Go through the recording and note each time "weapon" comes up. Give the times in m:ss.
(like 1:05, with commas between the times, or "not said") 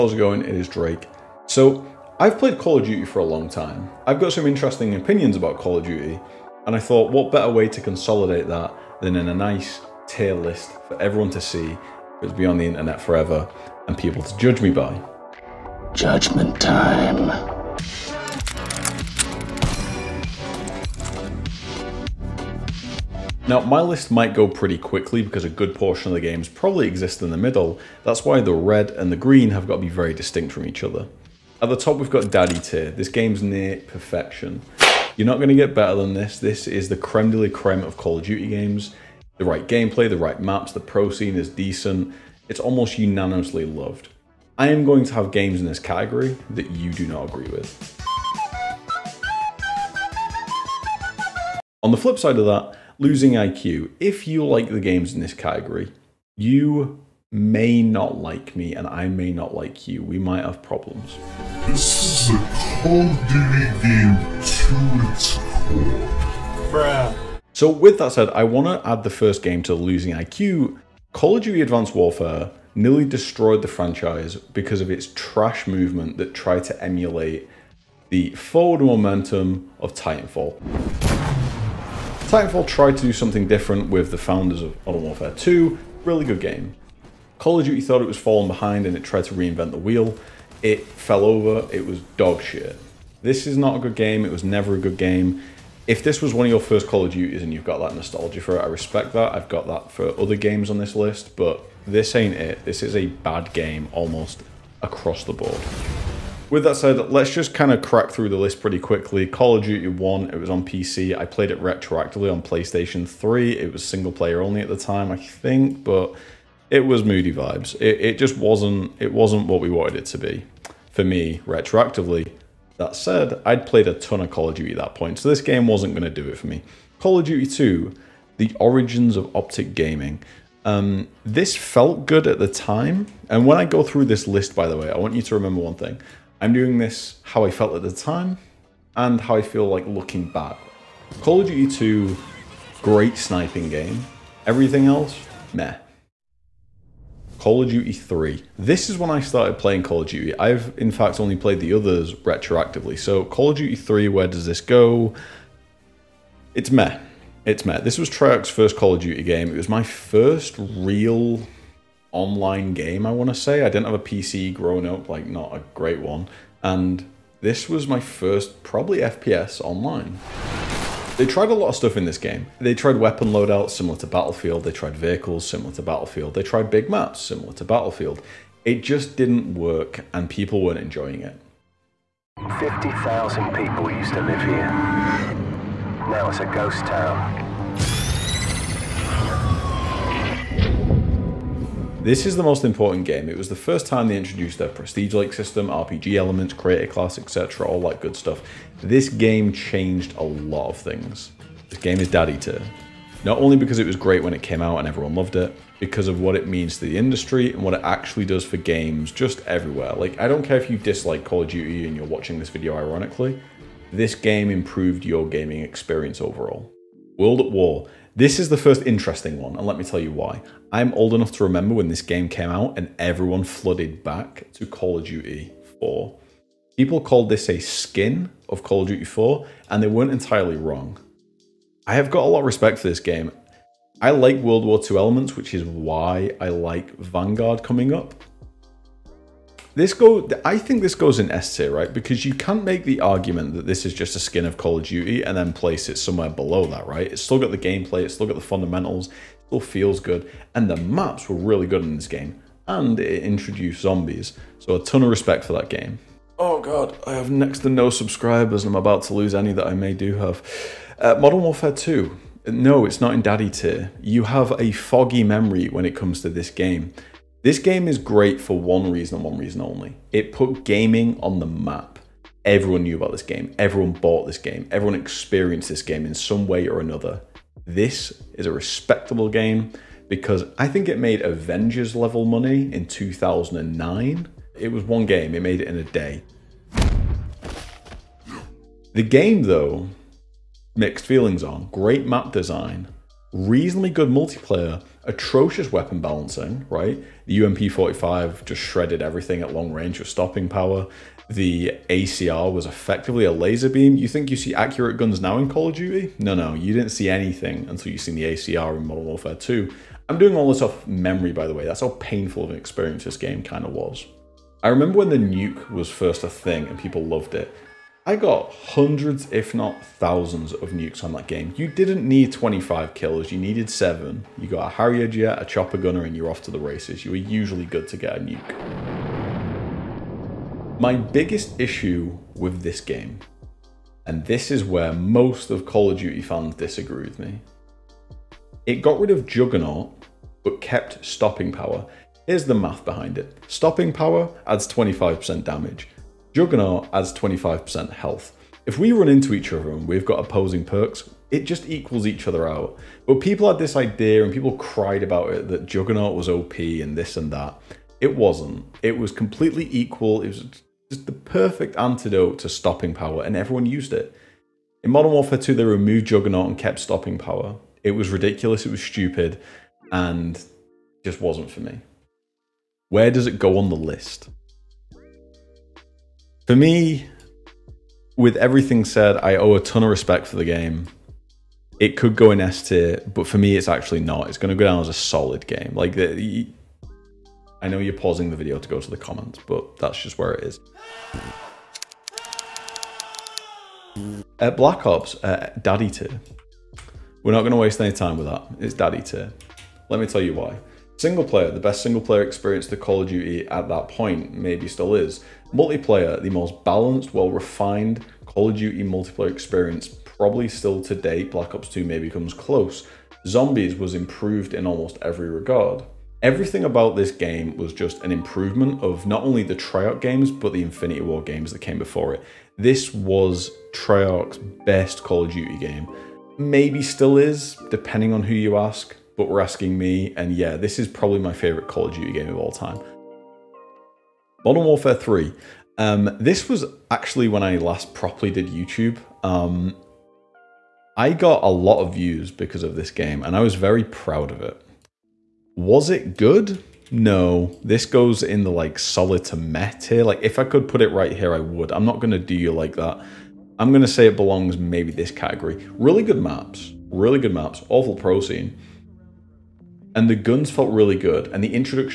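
2:52, 4:55.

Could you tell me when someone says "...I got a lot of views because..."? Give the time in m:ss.
7:20.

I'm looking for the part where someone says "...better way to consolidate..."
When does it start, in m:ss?
0:07.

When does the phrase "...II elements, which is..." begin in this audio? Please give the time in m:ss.
3:54.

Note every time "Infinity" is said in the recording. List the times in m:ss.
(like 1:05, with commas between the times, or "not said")
7:00.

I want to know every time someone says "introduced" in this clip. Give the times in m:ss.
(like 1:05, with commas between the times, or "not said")
3:14, 4:13.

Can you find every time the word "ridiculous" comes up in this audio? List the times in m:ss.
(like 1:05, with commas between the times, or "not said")
6:08.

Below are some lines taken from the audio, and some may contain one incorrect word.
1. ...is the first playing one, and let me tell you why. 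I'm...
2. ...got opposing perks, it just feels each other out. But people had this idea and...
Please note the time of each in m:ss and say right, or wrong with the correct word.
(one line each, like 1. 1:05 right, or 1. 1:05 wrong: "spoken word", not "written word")
1. 3:38 wrong: "interesting", not "playing"
2. 5:50 wrong: "equals", not "feels".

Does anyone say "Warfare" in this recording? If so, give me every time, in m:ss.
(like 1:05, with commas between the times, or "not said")
1:11, 1:25, 4:21, 5:09, 6:05, 7:14.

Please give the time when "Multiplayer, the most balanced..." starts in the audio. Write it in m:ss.
6:45.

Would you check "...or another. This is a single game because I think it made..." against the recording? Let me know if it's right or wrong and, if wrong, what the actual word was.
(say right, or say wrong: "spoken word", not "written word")
wrong: "respectable", not "single".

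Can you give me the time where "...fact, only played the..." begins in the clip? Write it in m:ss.
2:30.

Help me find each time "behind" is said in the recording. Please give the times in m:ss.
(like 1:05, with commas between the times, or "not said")
1:28, 5:42.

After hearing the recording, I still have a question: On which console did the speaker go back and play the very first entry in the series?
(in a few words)
PlayStation 3.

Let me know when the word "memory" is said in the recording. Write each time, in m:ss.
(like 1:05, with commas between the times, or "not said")
4:25, 5:10.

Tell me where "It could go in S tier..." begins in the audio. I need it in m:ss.
6:21.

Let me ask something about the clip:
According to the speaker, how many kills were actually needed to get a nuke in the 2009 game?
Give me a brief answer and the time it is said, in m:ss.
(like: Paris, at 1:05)
7, at 5:23.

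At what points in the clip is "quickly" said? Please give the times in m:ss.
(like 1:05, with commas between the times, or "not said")
0:24, 1:48.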